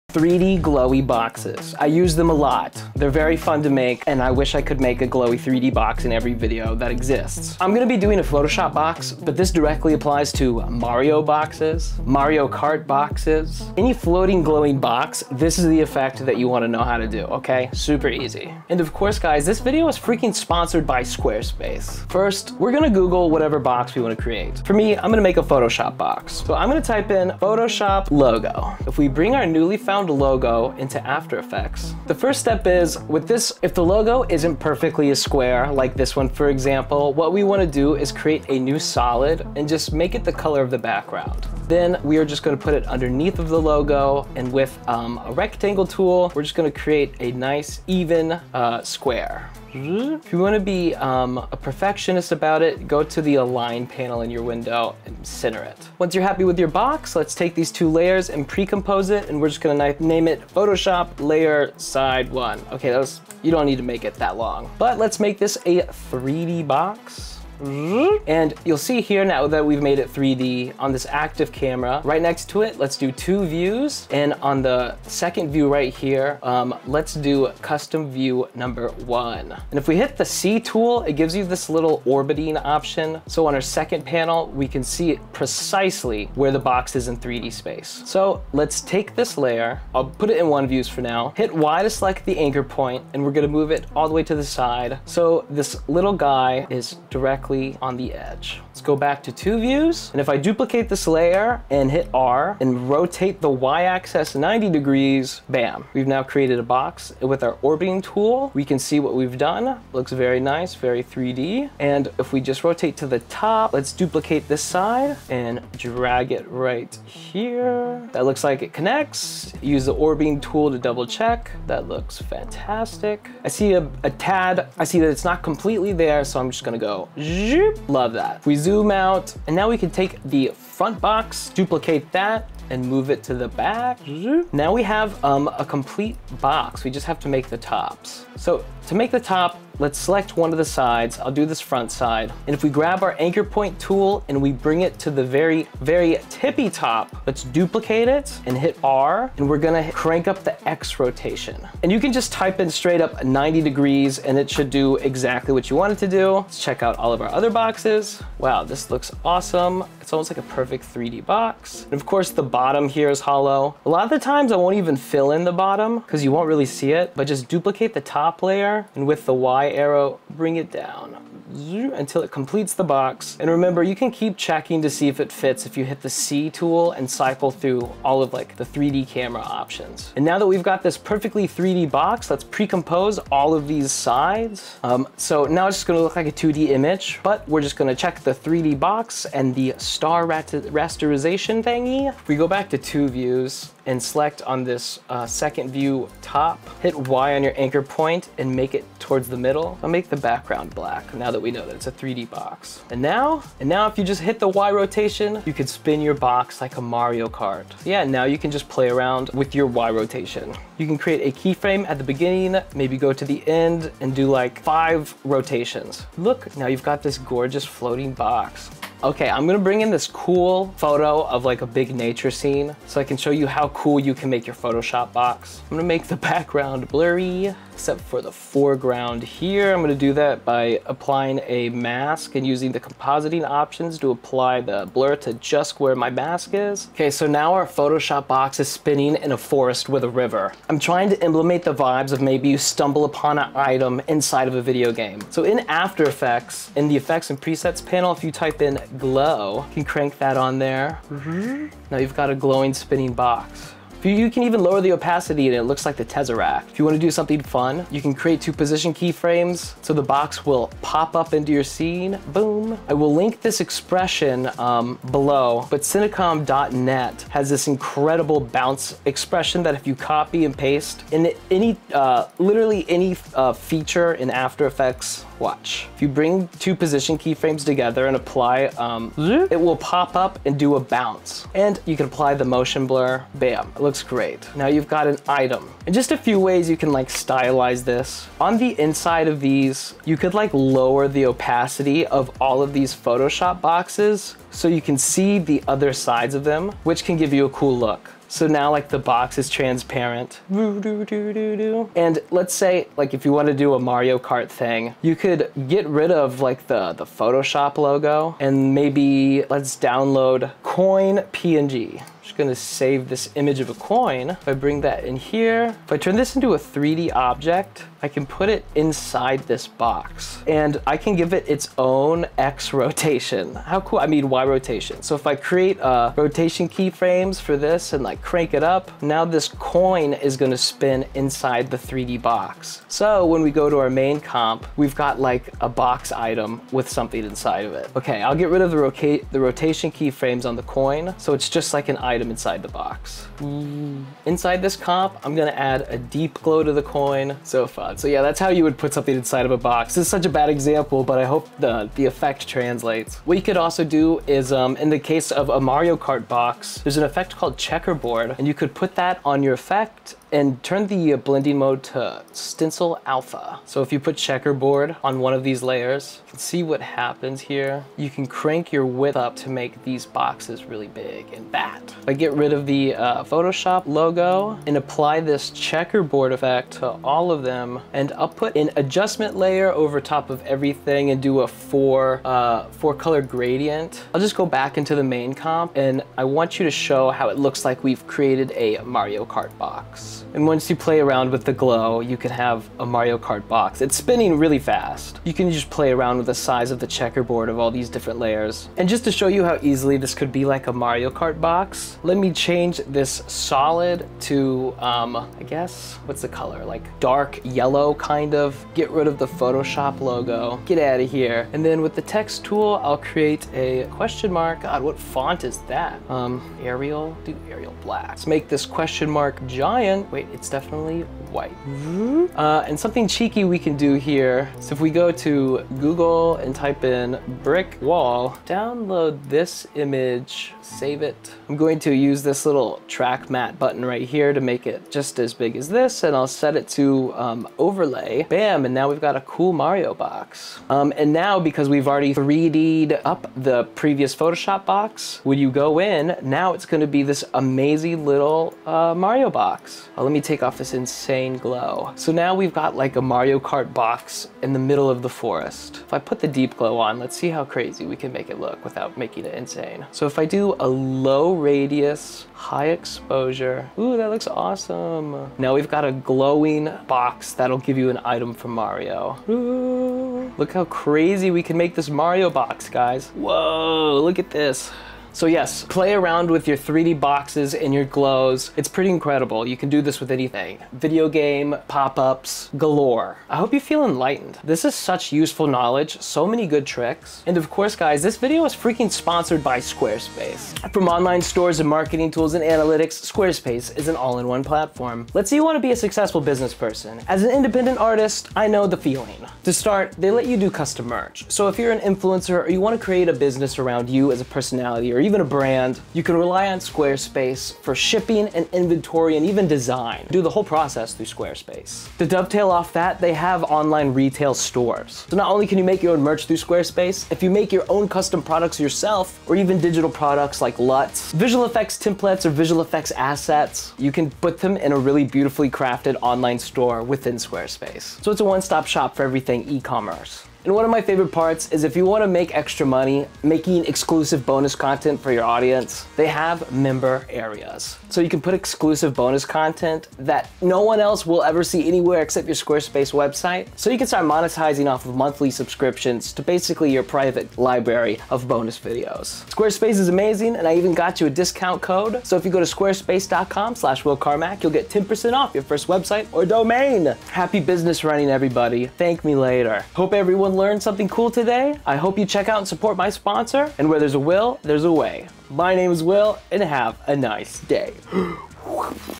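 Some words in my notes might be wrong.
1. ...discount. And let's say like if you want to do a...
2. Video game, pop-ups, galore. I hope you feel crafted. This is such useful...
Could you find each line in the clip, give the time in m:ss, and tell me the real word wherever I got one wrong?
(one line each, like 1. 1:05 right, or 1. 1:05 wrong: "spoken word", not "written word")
1. 4:59 wrong: "transparent", not "discount"
2. 8:00 wrong: "enlightened", not "crafted".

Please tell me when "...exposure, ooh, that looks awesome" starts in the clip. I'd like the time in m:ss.
7:42.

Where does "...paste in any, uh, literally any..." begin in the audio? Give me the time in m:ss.
4:30.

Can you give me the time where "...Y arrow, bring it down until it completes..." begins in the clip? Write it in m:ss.
2:49.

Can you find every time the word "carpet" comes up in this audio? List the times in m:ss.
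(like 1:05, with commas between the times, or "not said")
not said.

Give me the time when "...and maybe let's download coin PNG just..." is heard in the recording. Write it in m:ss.
5:08.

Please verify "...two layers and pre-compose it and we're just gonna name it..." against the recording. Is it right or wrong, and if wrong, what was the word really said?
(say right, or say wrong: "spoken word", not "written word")
right.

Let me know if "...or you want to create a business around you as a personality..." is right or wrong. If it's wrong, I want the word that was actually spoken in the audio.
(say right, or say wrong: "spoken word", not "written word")
right.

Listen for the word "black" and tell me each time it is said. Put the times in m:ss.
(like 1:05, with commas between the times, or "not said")
3:20, 6:57.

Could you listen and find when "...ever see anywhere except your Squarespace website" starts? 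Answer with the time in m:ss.
9:01.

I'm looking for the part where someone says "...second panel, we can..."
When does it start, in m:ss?
1:23.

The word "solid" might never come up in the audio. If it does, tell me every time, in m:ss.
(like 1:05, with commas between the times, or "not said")
0:38, 6:43.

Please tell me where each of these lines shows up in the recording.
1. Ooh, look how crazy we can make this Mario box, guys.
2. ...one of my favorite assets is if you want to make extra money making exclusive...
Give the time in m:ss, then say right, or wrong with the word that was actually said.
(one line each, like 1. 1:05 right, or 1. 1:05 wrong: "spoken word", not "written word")
1. 7:49 right
2. 8:50 wrong: "parts", not "assets".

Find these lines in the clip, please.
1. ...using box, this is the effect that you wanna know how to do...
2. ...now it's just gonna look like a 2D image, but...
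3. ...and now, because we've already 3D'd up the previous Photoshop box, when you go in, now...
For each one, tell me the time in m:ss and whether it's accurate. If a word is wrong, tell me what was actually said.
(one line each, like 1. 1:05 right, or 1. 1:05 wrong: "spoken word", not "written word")
1. 0:14 wrong: "glowing", not "using"
2. 3:05 right
3. 7:20 right.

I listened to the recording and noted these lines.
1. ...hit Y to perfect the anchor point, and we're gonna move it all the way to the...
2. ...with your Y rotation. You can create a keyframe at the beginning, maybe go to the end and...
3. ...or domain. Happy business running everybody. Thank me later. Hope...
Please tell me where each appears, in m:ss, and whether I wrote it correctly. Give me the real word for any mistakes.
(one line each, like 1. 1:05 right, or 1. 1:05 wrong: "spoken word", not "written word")
1. 1:31 wrong: "select", not "perfect"
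2. 3:29 right
3. 9:16 right.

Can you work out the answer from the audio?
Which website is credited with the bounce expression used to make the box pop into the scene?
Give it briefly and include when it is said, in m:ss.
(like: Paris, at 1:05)
Cinecom.net, at 4:25.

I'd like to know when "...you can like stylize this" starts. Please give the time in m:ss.
4:46.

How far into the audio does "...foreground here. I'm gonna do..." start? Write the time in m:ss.
3:48.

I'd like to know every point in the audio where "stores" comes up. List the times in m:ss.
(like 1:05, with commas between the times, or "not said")
8:11, 8:34, 8:46.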